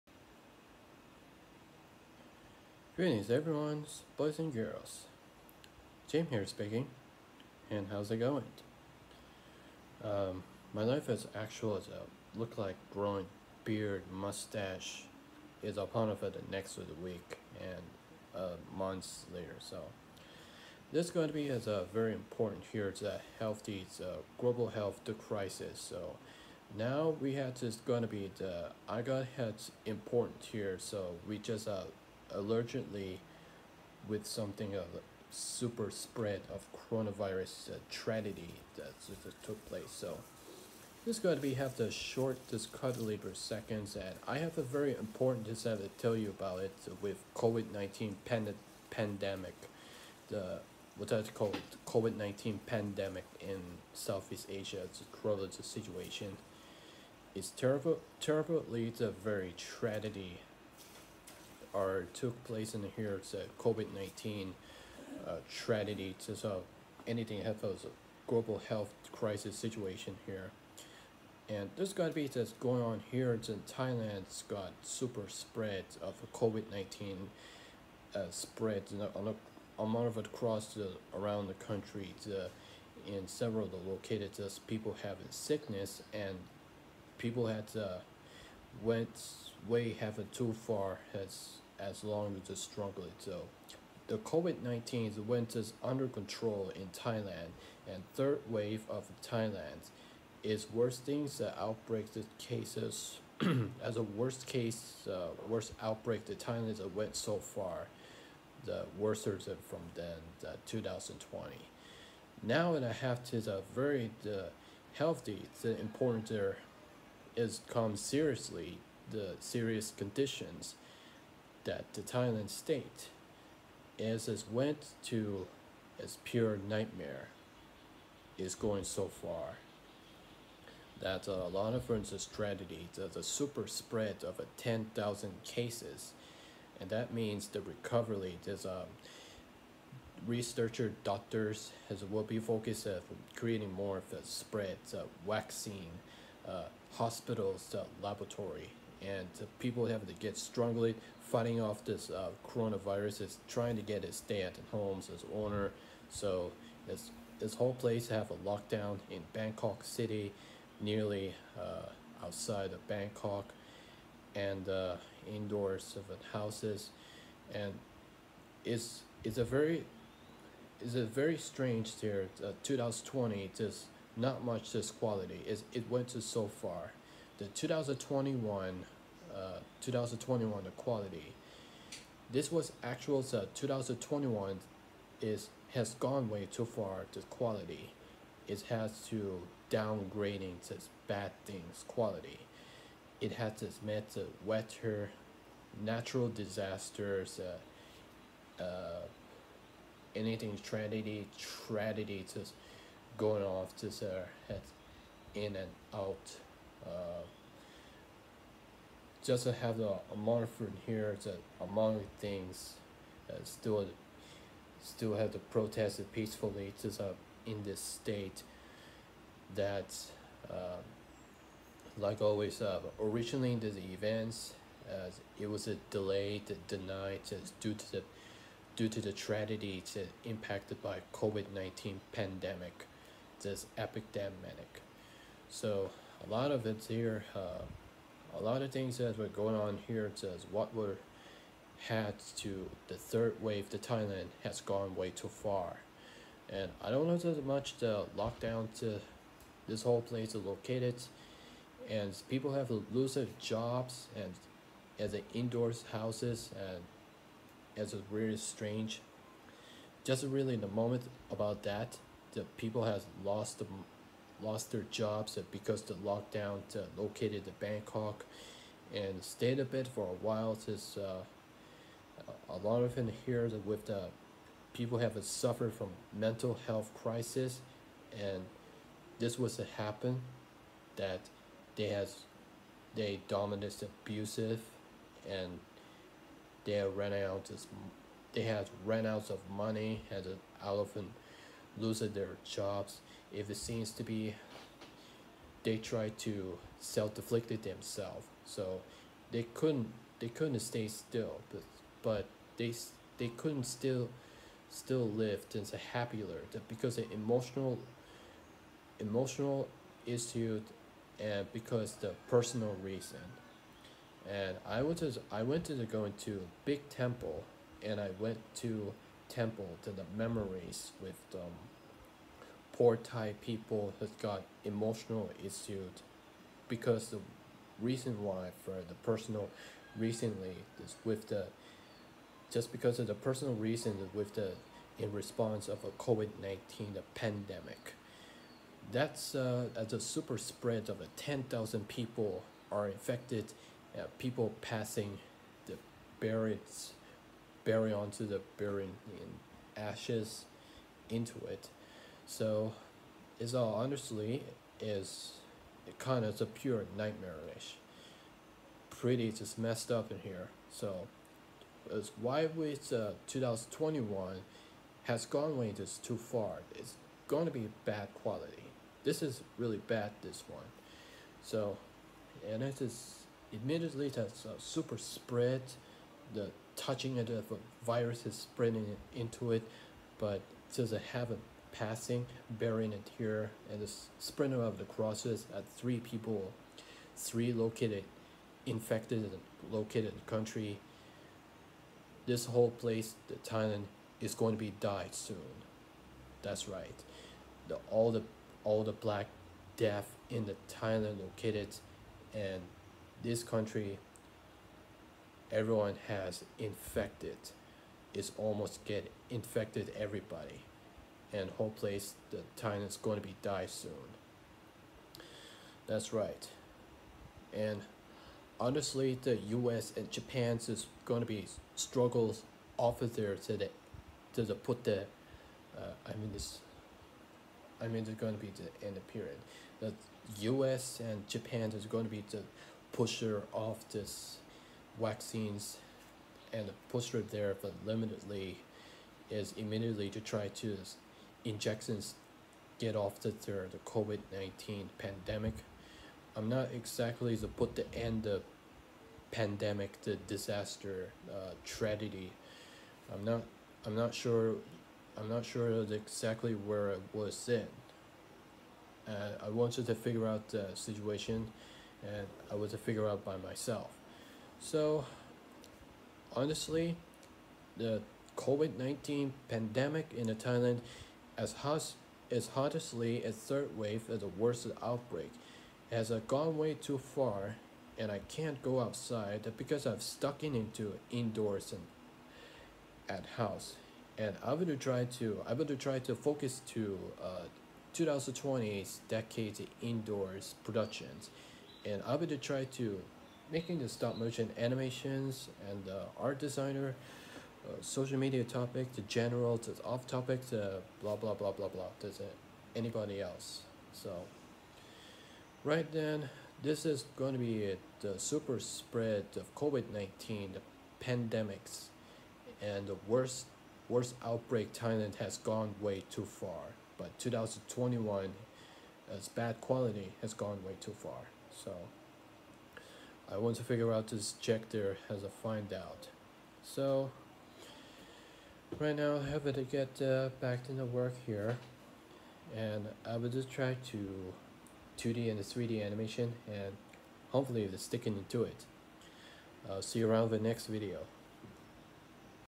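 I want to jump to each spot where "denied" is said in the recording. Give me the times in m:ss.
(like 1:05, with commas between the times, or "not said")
3:46.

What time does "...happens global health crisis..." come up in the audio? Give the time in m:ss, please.
1:07.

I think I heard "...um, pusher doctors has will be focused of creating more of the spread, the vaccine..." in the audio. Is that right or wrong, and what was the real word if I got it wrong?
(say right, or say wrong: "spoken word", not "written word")
wrong: "researcher", not "pusher".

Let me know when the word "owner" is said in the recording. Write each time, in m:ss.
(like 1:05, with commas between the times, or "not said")
2:35.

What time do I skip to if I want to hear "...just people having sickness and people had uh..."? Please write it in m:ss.
1:24.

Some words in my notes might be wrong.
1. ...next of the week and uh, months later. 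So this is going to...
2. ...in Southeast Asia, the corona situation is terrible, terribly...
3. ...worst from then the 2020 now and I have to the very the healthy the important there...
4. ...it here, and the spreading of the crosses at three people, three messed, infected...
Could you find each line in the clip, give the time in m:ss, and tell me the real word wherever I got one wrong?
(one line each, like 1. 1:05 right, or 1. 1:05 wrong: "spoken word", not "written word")
1. 0:16 right
2. 0:53 right
3. 1:48 right
4. 6:22 wrong: "located", not "messed".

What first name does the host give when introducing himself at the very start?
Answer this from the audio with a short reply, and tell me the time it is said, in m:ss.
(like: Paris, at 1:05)
Jim, at 0:06.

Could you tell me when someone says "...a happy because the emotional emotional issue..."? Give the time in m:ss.
5:05.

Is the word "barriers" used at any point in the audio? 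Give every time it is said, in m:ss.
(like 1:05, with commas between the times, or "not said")
5:46.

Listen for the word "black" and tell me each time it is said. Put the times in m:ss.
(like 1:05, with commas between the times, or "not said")
6:38.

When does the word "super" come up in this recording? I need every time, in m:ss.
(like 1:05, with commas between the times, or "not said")
0:35, 1:14, 2:13, 5:40, 6:14, 8:28.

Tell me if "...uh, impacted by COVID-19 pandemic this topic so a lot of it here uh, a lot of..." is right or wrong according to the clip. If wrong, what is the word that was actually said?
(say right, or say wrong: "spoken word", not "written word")
wrong: "epidemic", not "topic".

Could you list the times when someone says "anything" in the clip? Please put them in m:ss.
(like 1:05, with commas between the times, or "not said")
1:07, 3:20.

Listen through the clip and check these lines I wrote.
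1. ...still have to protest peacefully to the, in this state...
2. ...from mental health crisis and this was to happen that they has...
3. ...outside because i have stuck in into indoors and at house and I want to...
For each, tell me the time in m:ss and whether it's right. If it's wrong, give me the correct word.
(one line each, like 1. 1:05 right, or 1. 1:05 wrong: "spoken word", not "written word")
1. 3:34 right
2. 4:35 right
3. 7:58 right.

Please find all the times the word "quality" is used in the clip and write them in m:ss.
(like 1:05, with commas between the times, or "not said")
2:54, 3:00, 3:07, 3:11, 6:08, 8:39.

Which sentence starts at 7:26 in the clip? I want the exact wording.
I'm not exactly to put the end the pandemic, the disaster, uh, tragedy.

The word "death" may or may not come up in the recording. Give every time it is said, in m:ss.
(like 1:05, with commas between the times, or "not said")
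6:39.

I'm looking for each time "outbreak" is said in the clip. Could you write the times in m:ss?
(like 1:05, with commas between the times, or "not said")
1:41, 1:45, 7:54, 8:34.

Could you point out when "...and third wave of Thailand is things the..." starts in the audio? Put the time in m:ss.
1:37.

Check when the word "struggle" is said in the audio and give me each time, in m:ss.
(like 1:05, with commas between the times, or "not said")
1:32, 7:01.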